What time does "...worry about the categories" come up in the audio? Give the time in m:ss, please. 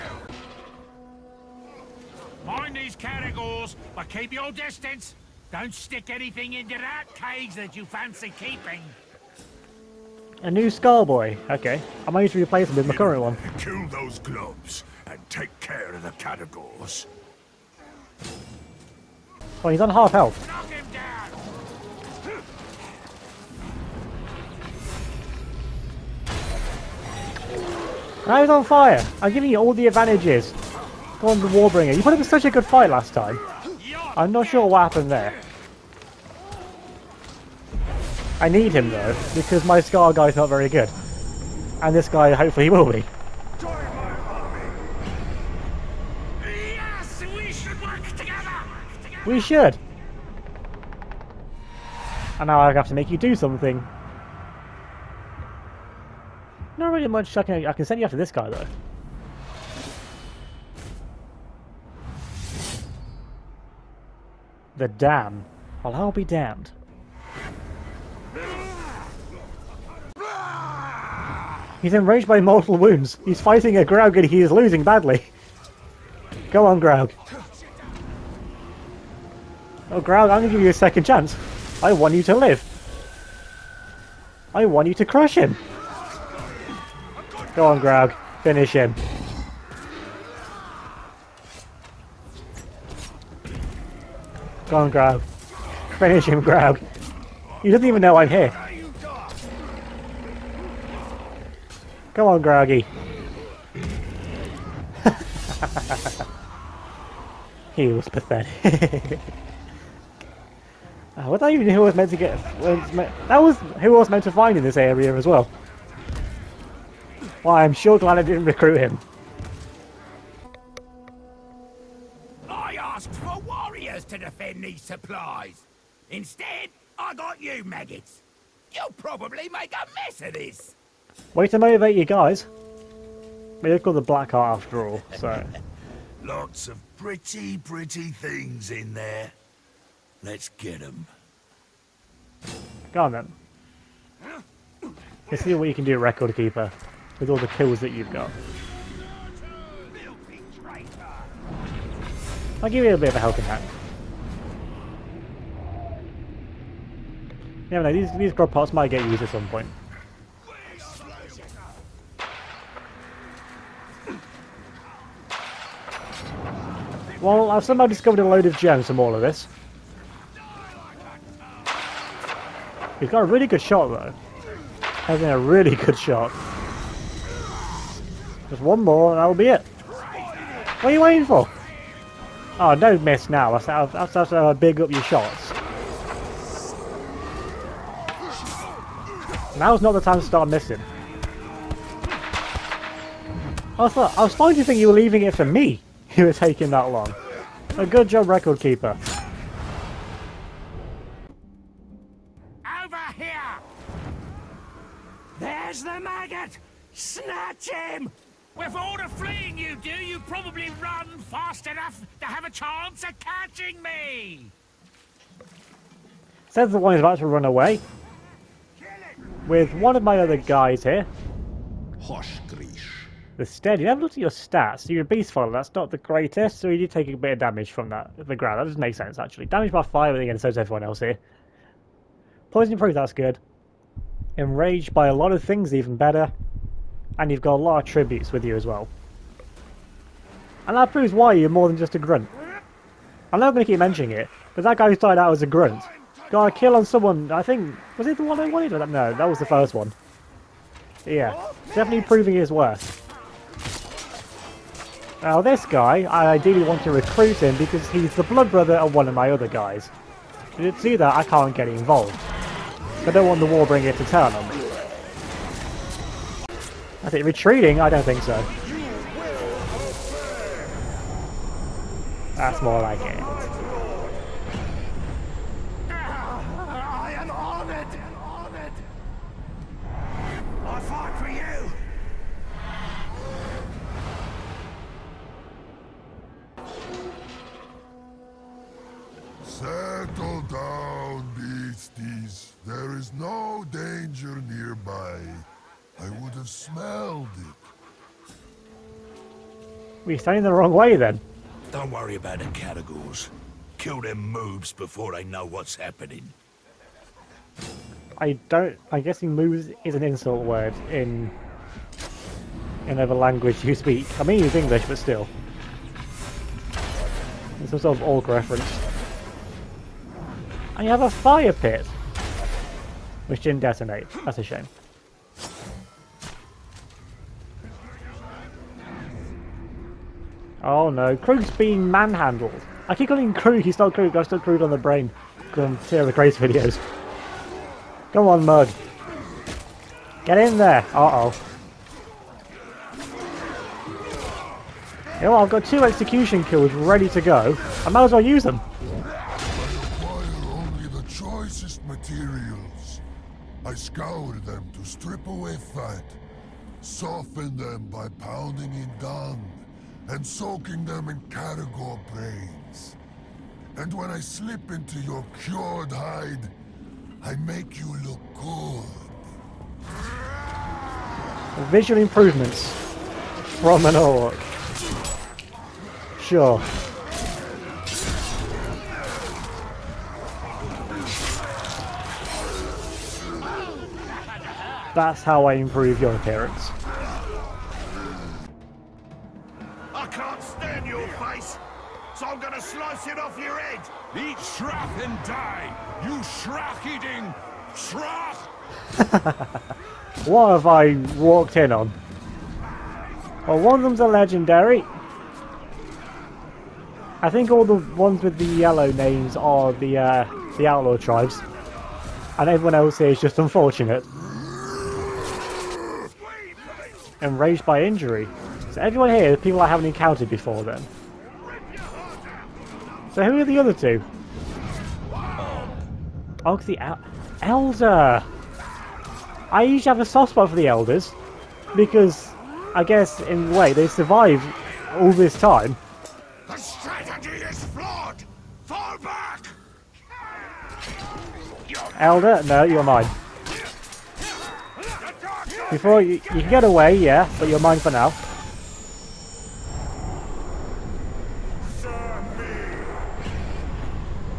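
5:01.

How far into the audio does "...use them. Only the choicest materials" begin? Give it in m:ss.
5:48.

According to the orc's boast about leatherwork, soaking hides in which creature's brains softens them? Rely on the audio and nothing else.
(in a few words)
Caragor.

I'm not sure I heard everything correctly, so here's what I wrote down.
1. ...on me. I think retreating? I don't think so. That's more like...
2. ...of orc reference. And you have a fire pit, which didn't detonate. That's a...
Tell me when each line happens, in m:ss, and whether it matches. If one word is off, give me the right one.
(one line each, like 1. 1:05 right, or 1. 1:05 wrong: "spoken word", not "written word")
1. 4:24 right
2. 5:17 right.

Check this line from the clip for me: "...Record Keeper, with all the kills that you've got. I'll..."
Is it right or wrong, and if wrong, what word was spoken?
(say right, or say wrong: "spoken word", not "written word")
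right.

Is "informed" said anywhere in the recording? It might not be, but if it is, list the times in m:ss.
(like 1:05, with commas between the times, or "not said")
not said.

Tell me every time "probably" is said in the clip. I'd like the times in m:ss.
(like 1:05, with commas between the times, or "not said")
2:08, 3:30.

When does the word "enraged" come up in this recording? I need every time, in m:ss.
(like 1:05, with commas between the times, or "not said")
1:11, 3:54, 6:57.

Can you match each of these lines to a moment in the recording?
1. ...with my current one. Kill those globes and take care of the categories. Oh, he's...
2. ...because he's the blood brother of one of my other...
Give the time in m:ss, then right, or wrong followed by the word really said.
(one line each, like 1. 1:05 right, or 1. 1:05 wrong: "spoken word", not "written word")
1. 0:12 right
2. 4:17 right.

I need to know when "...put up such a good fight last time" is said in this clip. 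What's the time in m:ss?
0:32.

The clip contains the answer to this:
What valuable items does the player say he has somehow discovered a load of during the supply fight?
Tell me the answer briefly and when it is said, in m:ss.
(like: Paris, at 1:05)
Gems, at 2:48.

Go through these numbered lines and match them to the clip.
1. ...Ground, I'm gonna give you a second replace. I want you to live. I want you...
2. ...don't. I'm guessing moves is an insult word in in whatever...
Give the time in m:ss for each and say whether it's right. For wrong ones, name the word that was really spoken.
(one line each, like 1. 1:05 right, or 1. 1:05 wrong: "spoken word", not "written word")
1. 1:19 wrong: "chance", not "replace"
2. 5:08 right.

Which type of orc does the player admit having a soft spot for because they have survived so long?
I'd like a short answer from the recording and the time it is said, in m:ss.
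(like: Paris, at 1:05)
Elders, at 7:10.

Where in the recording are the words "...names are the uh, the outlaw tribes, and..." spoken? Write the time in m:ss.
6:48.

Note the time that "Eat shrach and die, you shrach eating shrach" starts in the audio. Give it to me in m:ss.
6:34.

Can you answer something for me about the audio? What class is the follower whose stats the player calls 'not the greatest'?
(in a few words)
Beast follower.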